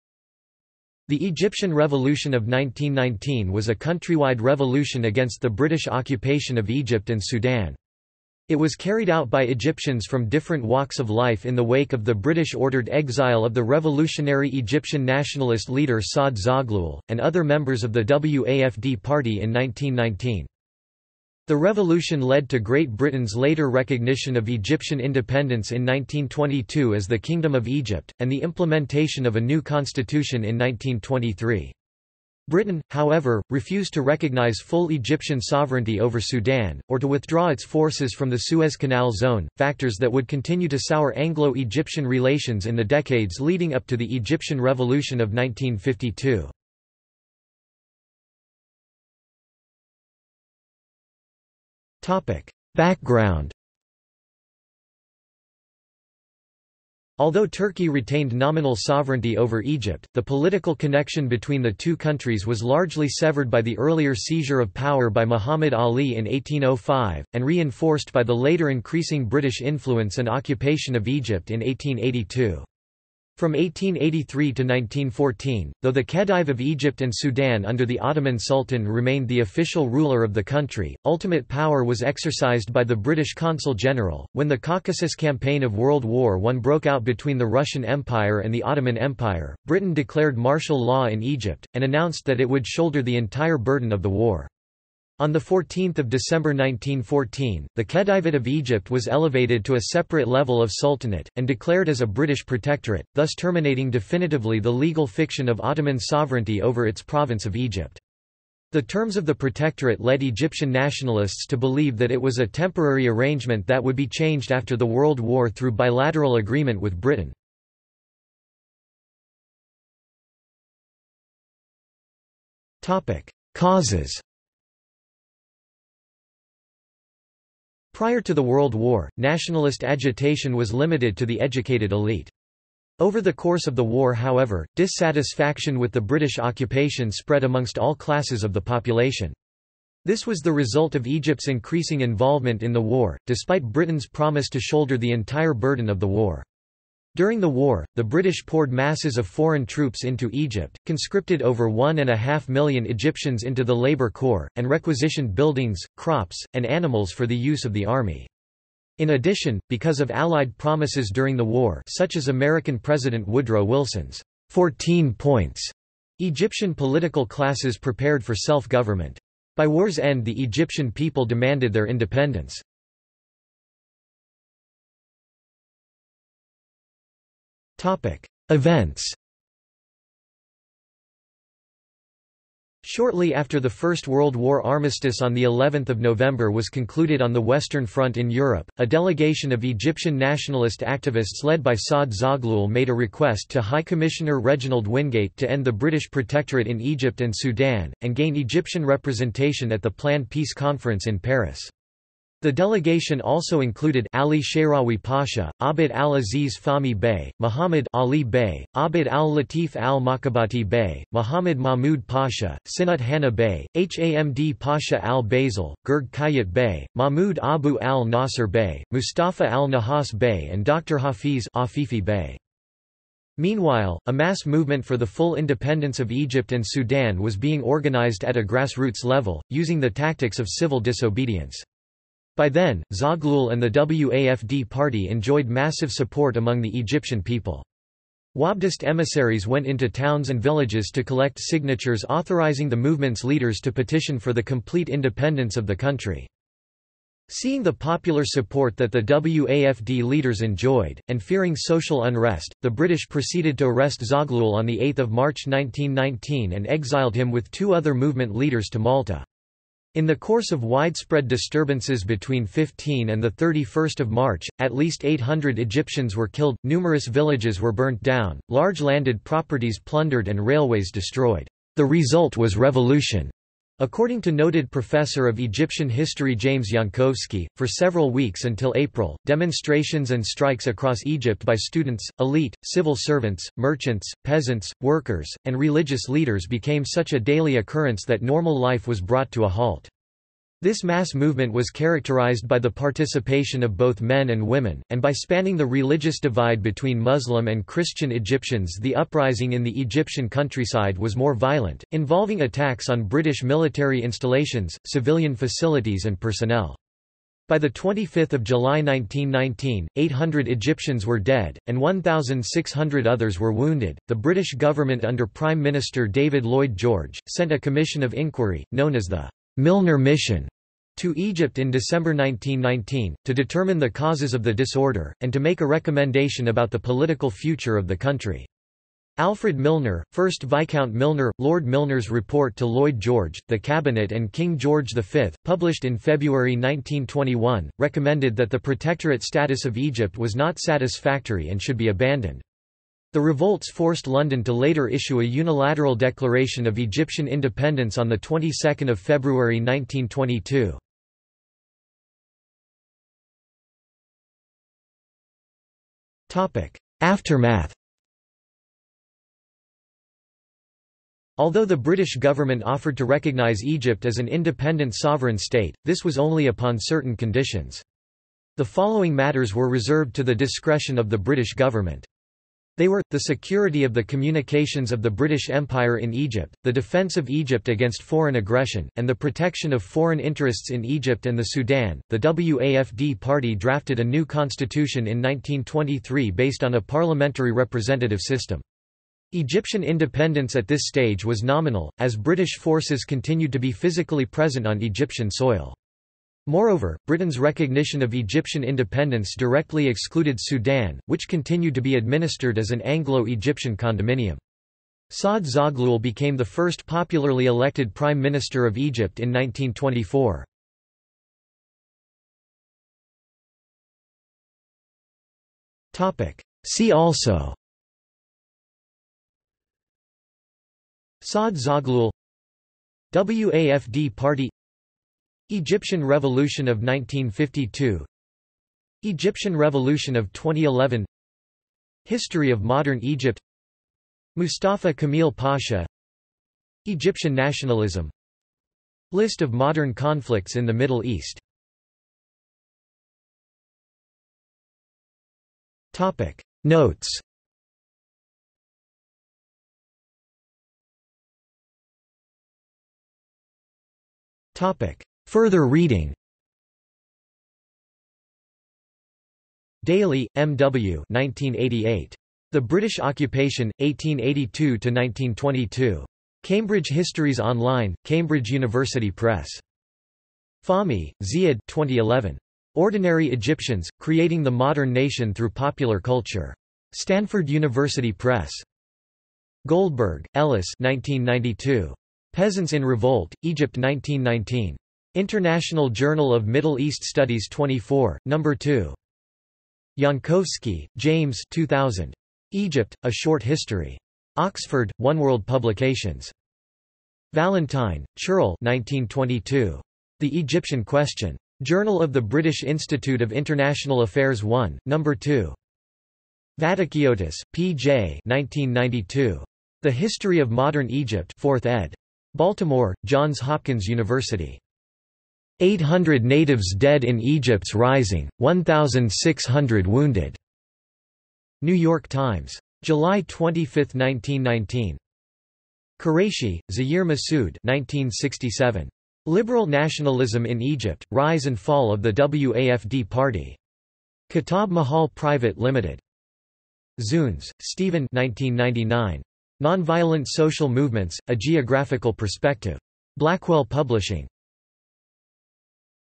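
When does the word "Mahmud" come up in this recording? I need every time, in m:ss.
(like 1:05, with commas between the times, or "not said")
3:31, 3:36.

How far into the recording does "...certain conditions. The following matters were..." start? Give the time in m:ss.
6:06.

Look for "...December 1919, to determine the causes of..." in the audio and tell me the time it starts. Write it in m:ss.
5:21.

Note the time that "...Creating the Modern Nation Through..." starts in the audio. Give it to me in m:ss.
7:54.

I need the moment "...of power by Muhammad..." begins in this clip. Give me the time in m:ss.
1:04.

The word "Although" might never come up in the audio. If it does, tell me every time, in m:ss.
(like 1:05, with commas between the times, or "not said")
0:57, 6:01.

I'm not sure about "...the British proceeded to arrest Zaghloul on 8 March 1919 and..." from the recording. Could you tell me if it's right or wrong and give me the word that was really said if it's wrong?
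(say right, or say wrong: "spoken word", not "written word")
right.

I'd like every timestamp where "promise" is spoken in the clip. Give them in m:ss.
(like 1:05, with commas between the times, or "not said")
2:24, 2:40.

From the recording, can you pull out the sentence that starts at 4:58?
The uprising in the Egyptian countryside was more violent, involving attacks on British military installations, civilian facilities, and personnel.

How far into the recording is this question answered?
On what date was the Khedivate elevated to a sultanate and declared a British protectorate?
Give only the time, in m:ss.
1:35.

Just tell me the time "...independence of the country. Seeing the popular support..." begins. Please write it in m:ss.
4:04.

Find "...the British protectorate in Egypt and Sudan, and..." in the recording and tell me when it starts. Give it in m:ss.
3:15.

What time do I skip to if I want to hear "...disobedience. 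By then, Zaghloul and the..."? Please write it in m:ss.
3:50.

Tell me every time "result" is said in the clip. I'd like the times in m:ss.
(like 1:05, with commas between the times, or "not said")
2:20, 4:31.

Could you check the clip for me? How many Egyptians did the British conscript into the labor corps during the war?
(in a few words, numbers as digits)
over one and a half million.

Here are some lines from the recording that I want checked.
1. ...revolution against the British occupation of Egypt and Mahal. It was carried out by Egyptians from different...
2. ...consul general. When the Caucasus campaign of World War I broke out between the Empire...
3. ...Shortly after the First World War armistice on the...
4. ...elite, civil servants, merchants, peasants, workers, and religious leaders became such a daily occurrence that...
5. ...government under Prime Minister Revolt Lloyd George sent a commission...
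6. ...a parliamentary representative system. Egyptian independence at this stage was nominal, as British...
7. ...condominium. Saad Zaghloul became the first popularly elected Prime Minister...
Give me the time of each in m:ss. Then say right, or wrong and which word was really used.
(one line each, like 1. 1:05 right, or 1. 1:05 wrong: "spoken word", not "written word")
1. 0:04 wrong: "Sudan", not "Mahal"
2. 1:23 wrong: "Russian", not "Empire"
3. 3:02 right
4. 4:42 right
5. 5:14 wrong: "David", not "Revolt"
6. 6:26 right
7. 6:43 right.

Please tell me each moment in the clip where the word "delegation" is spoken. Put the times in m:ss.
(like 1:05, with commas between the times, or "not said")
3:08, 3:22.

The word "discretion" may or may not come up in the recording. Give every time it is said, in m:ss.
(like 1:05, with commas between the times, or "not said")
6:10.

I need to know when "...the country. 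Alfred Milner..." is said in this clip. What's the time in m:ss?
5:27.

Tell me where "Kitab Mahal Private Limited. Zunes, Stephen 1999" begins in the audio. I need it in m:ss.
8:54.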